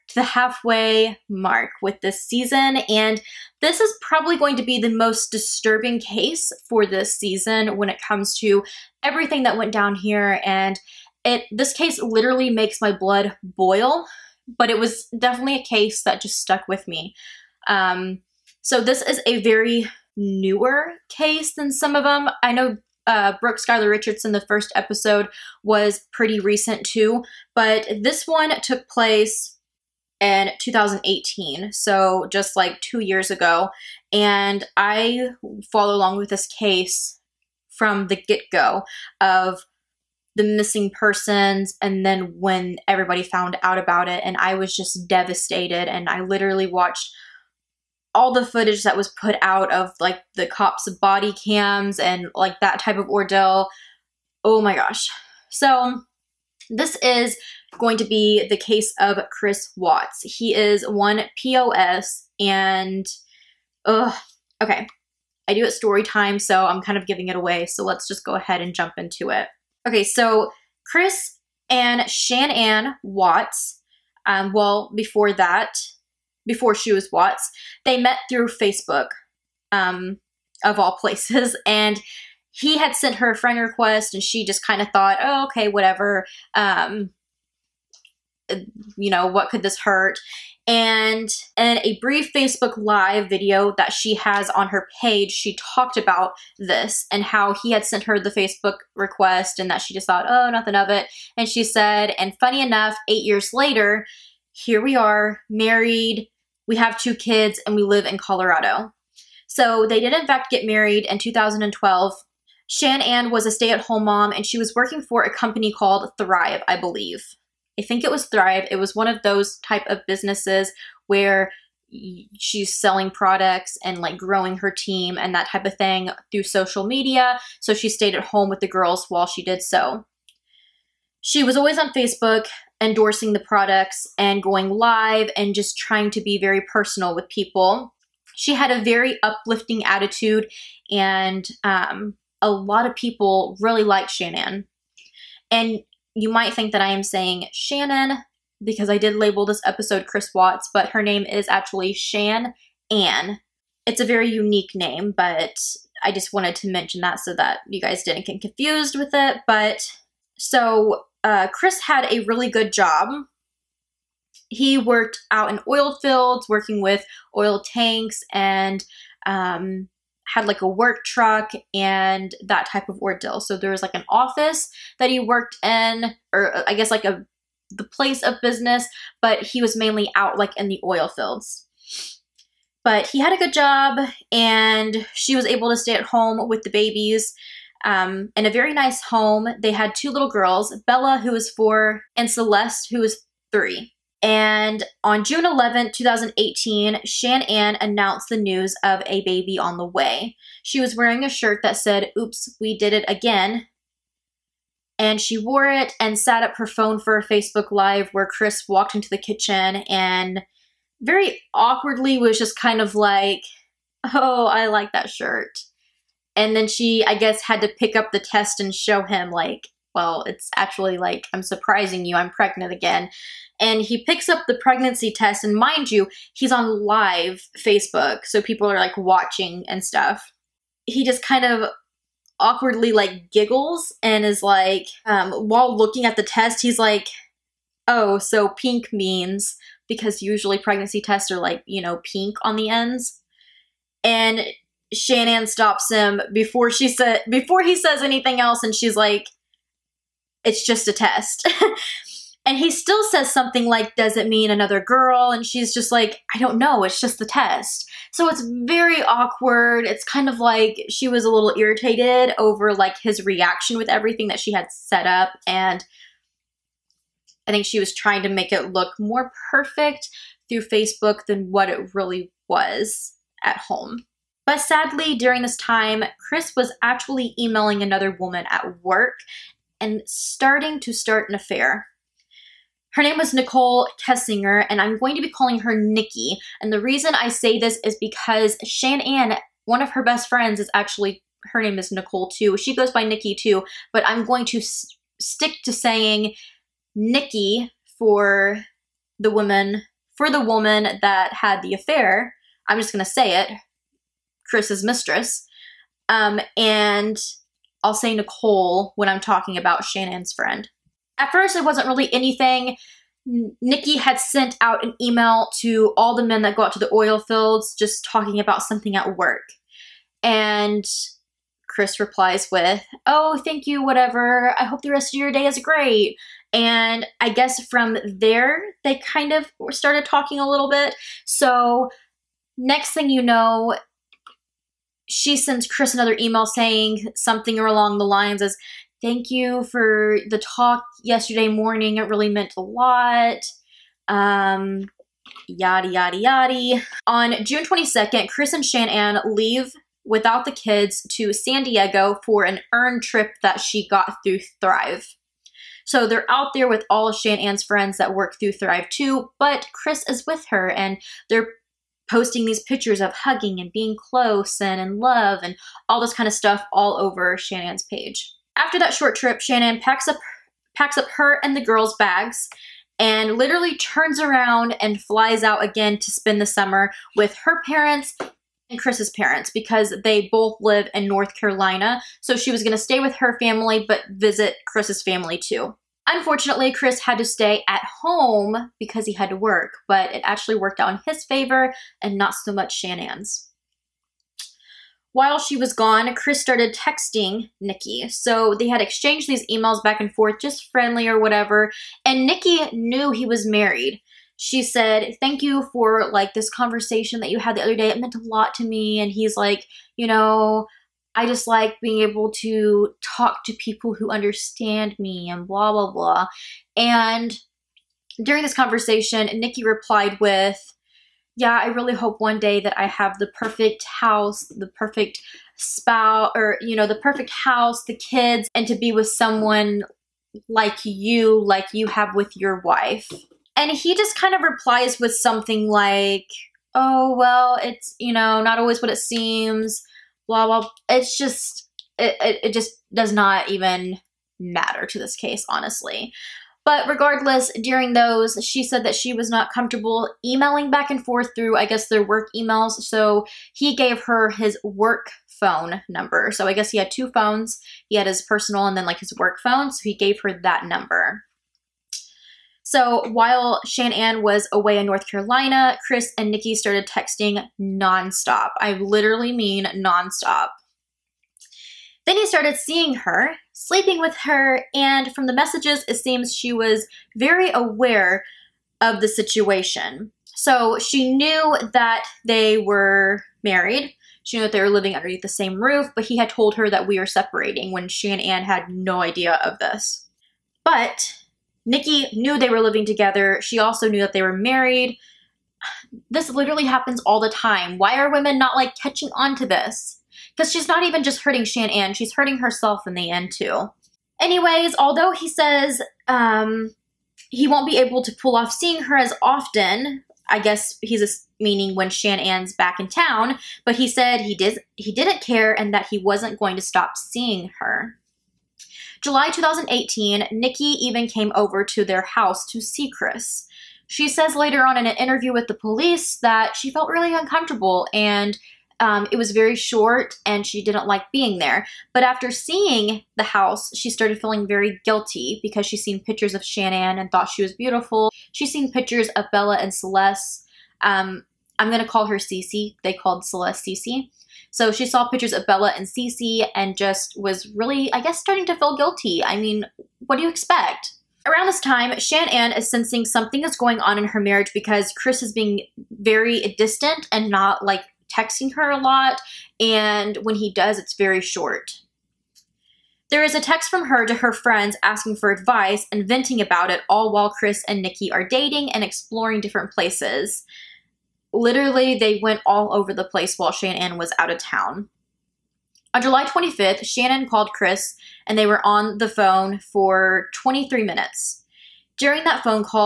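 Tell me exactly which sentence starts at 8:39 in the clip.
July 2018, Nikki even came over to their house to see Chris.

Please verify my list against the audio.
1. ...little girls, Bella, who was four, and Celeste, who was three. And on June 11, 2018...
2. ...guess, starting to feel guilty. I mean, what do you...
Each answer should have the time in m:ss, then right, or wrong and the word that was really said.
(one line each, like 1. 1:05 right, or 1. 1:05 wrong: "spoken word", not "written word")
1. 3:10 right
2. 9:08 right.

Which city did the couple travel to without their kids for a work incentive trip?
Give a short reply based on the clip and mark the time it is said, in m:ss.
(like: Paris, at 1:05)
San Diego, at 5:51.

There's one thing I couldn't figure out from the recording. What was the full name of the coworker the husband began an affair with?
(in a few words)
Nichol Kessinger.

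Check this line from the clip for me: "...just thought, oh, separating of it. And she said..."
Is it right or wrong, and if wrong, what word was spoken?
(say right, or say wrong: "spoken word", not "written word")
wrong: "nothing", not "separating".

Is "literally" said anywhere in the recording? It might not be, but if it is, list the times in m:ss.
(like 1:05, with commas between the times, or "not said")
0:12, 0:46, 6:13, 7:48, 8:16, 9:31.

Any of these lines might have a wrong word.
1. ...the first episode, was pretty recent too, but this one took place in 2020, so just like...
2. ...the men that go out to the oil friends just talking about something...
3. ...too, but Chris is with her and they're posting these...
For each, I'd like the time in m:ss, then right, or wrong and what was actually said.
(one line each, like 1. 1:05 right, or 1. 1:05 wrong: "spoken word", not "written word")
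1. 0:24 wrong: "2018", not "2020"
2. 5:16 wrong: "fields", not "friends"
3. 5:58 right.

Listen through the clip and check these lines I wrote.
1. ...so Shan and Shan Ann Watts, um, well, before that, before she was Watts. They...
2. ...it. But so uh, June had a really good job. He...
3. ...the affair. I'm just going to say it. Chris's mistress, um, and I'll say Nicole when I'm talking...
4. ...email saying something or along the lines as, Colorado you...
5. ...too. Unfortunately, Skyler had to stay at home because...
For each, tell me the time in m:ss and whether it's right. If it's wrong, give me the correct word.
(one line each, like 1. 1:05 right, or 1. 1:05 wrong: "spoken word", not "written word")
1. 1:10 wrong: "Chris", not "Shan"
2. 2:39 wrong: "Chris", not "June"
3. 5:01 right
4. 5:36 wrong: "Thank", not "Colorado"
5. 6:25 wrong: "Chris", not "Skyler".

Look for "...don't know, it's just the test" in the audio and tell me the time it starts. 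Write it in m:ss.
4:16.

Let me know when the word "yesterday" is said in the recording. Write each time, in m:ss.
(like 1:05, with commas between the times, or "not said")
5:41.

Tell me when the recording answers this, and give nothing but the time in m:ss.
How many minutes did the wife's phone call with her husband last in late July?
9:40.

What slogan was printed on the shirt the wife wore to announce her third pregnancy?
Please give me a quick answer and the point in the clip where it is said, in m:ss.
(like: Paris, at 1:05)
Oops, we did it again, at 3:22.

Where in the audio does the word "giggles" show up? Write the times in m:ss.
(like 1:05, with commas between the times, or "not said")
3:53.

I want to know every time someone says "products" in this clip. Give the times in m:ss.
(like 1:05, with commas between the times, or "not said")
2:03, 2:13.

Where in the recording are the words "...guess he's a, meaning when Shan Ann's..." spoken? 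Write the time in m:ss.
8:30.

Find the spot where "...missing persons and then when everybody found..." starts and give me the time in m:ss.
0:40.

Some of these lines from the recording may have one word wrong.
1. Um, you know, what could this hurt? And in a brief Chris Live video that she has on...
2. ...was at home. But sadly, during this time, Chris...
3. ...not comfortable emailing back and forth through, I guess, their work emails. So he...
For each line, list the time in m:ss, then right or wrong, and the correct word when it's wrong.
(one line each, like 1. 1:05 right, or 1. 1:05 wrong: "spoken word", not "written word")
1. 1:26 wrong: "Facebook", not "Chris"
2. 4:32 right
3. 7:29 right.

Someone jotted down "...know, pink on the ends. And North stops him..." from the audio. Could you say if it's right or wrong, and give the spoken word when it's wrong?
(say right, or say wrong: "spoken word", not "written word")
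wrong: "Shannon", not "North".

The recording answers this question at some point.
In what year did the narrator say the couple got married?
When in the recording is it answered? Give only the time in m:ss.
1:51.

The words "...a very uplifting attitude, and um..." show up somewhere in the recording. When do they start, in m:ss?
2:18.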